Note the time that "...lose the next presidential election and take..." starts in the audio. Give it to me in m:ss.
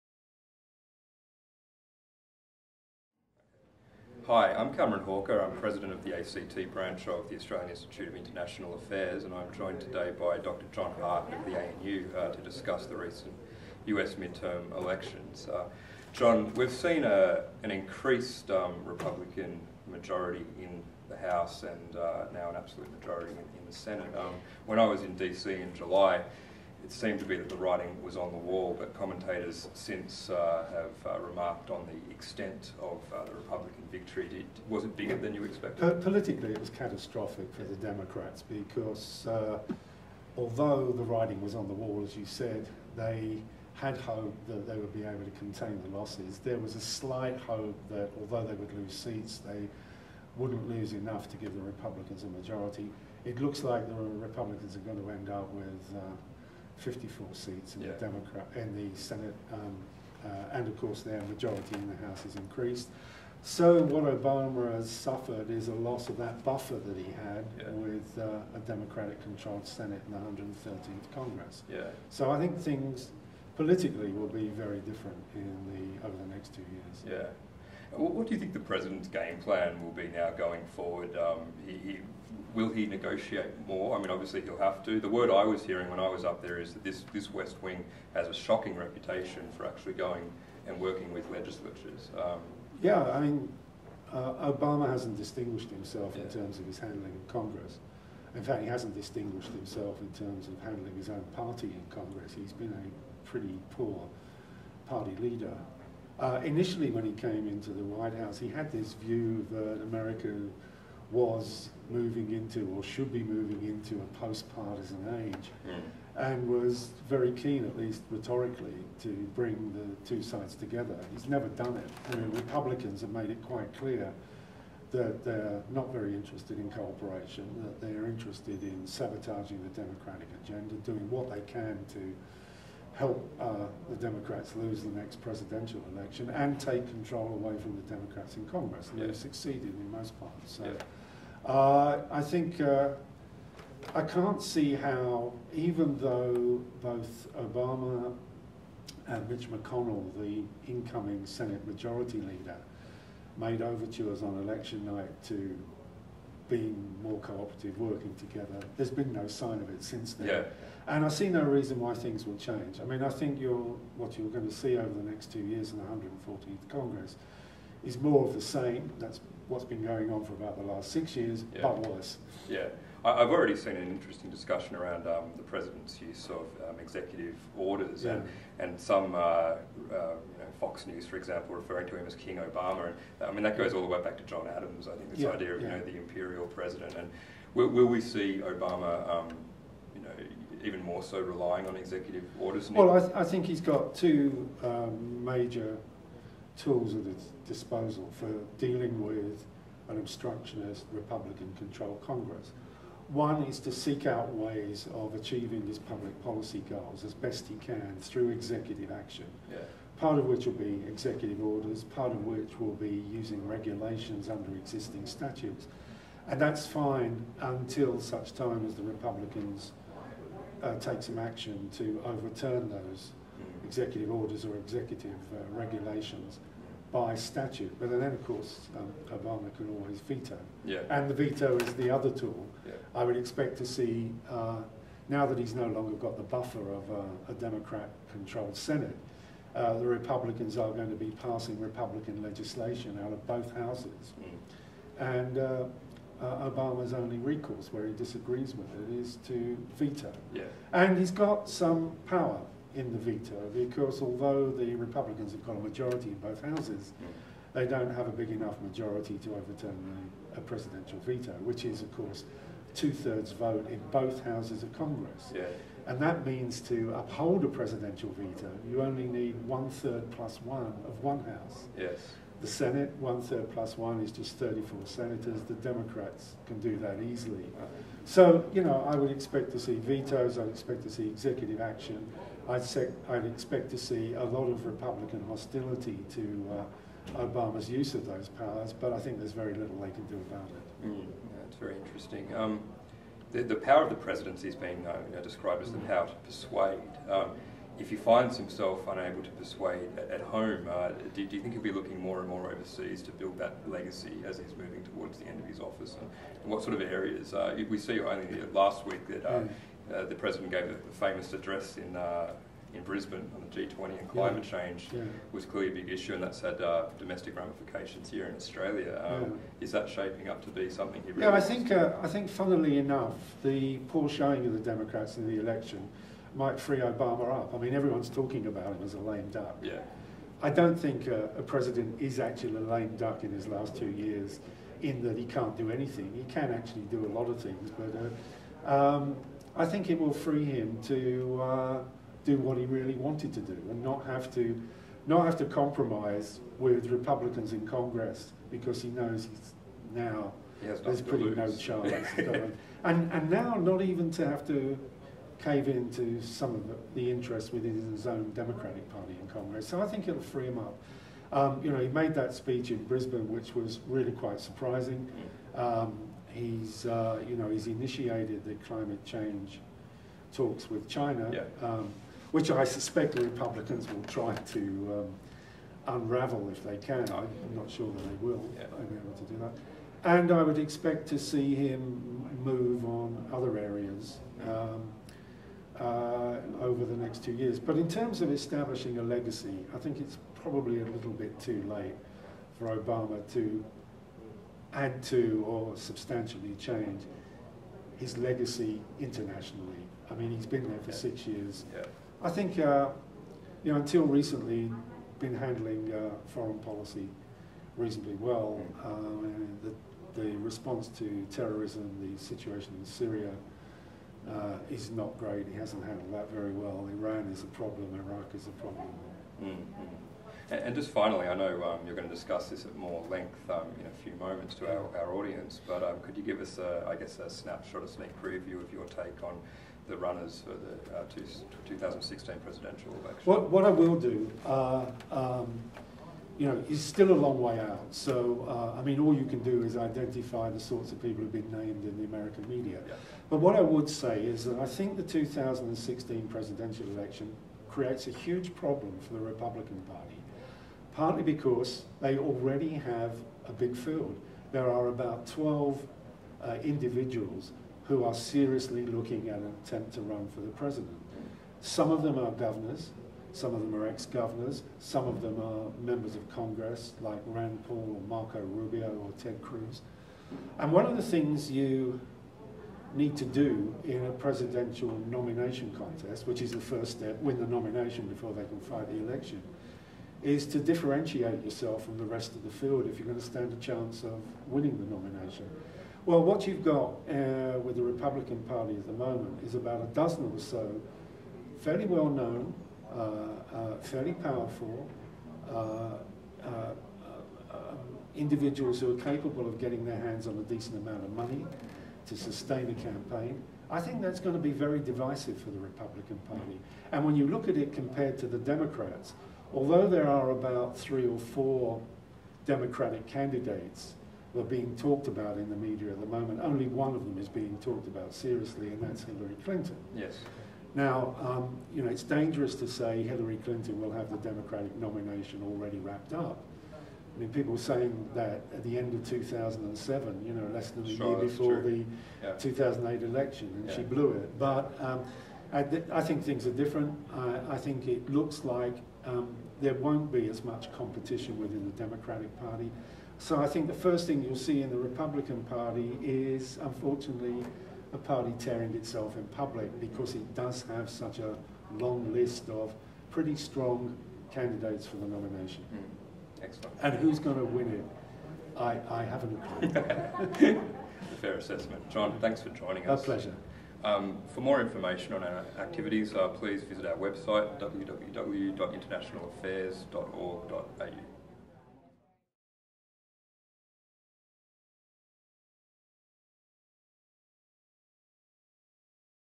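2:14.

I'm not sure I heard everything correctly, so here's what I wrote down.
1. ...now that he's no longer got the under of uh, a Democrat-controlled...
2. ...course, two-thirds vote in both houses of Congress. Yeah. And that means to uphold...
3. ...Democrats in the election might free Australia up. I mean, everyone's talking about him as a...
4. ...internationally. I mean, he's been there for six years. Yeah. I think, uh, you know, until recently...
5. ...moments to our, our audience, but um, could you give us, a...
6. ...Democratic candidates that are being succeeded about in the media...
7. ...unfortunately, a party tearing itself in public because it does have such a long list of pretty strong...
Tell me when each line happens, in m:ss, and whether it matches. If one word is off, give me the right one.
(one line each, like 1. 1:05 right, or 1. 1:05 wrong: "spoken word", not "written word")
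1. 3:55 wrong: "buffer", not "under"
2. 4:21 right
3. 5:24 wrong: "Obama", not "Australia"
4. 6:38 right
5. 7:04 right
6. 8:32 wrong: "talked", not "succeeded"
7. 9:06 right.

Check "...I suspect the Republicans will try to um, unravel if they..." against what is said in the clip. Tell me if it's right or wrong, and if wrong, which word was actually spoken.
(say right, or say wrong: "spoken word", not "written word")
right.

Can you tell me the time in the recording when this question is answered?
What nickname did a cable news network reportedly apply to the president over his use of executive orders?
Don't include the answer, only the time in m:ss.
3:02.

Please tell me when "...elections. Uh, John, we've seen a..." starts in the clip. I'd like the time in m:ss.
0:14.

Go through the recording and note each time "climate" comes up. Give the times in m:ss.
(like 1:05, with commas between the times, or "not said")
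5:14, 6:08.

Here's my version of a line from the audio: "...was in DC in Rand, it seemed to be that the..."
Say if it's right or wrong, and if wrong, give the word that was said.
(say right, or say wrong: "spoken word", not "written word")
wrong: "July", not "Rand".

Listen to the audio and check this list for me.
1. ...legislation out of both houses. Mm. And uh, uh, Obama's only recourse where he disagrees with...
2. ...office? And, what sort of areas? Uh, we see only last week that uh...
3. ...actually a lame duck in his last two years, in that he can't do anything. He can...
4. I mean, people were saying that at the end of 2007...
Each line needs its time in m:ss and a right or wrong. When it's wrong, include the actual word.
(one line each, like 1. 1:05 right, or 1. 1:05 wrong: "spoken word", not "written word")
1. 4:02 right
2. 5:05 right
3. 5:32 right
4. 8:46 right.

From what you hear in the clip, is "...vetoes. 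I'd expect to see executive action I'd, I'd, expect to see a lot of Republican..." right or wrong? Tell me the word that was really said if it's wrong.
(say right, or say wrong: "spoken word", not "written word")
right.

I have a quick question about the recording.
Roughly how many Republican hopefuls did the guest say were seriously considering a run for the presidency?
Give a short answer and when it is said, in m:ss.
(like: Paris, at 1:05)
12, at 7:35.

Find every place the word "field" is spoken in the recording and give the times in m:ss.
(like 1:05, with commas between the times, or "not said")
7:33, 8:02.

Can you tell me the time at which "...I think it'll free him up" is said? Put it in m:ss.
5:59.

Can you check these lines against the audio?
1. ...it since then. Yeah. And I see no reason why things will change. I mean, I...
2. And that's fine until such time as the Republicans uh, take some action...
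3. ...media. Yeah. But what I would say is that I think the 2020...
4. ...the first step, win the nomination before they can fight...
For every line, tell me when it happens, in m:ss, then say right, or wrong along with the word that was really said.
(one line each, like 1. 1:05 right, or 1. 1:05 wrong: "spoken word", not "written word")
1. 2:39 right
2. 3:36 right
3. 7:22 wrong: "2016", not "2020"
4. 7:56 right.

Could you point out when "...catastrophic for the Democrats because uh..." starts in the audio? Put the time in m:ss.
0:36.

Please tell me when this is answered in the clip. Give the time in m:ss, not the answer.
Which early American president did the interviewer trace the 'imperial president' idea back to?
3:04.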